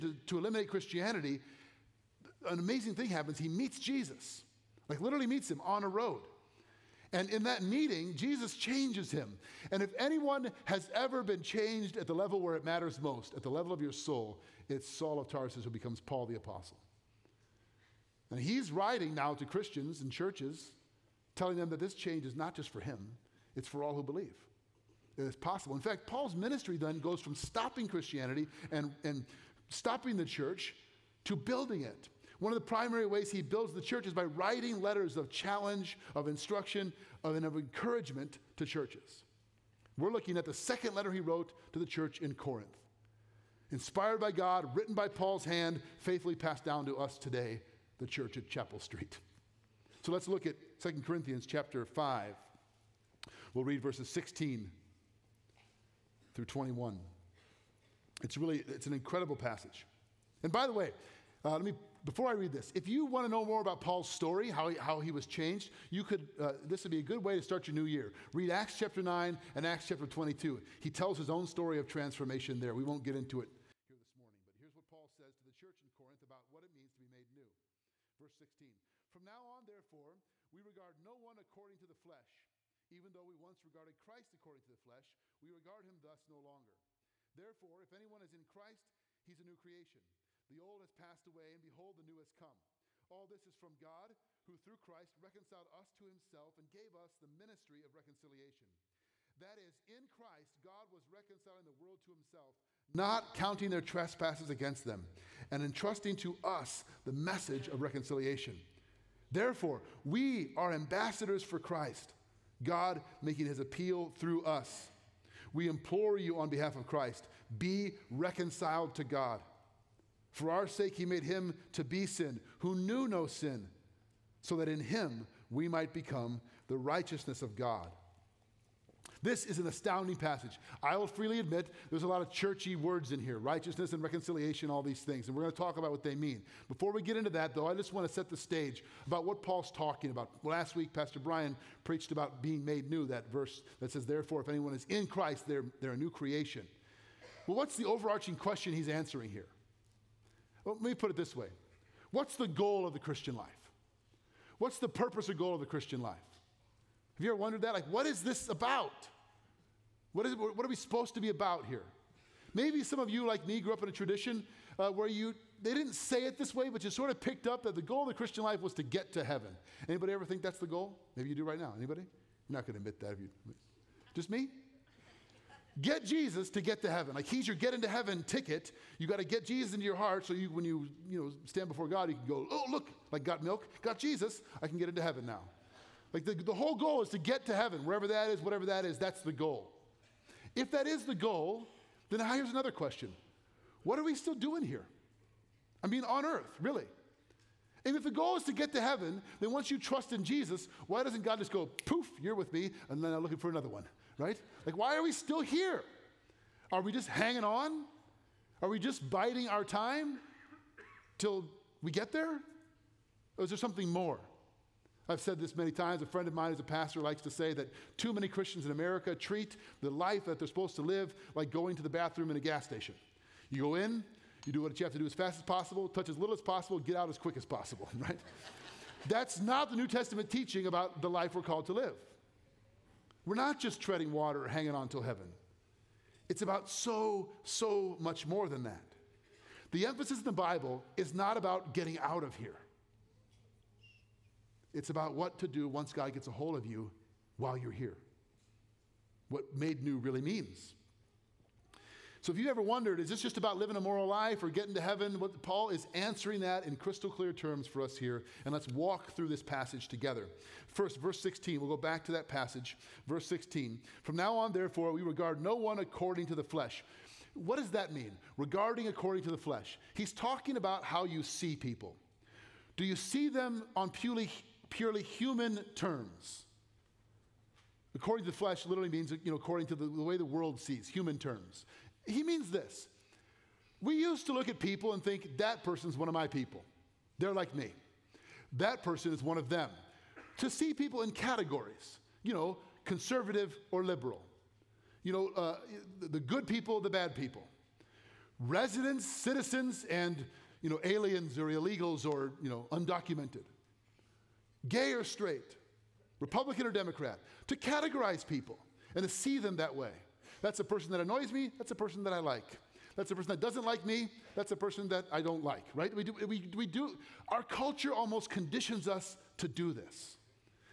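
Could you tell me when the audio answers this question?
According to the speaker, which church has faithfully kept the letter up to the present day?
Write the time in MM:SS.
00:48.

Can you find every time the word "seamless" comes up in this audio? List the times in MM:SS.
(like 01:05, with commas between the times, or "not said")
not said.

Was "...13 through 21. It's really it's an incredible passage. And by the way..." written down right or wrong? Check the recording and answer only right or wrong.
wrong.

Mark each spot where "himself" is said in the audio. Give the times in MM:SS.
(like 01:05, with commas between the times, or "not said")
01:36, 01:42.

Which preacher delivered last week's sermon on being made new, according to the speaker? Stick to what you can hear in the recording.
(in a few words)
Pastor Brian.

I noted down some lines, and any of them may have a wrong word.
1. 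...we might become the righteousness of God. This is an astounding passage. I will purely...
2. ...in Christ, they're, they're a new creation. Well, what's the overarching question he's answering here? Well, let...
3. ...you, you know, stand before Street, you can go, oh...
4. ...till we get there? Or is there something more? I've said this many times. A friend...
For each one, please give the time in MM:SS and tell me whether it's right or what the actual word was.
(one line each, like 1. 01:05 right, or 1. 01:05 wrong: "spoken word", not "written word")
1. 02:05 wrong: "freely", not "purely"
2. 02:24 right
3. 03:00 wrong: "God", not "Street"
4. 03:31 right.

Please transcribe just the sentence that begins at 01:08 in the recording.
Read Acts chapter 9 and Acts chapter 22.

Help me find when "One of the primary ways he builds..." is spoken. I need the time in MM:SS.
00:32.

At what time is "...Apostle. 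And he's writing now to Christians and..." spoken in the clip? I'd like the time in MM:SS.
00:16.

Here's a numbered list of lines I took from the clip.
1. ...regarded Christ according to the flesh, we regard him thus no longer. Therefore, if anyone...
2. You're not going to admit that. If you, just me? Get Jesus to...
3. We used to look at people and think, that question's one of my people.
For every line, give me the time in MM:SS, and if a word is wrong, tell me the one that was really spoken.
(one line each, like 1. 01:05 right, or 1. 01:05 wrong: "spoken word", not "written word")
1. 01:23 right
2. 02:52 right
3. 04:43 wrong: "person", not "question".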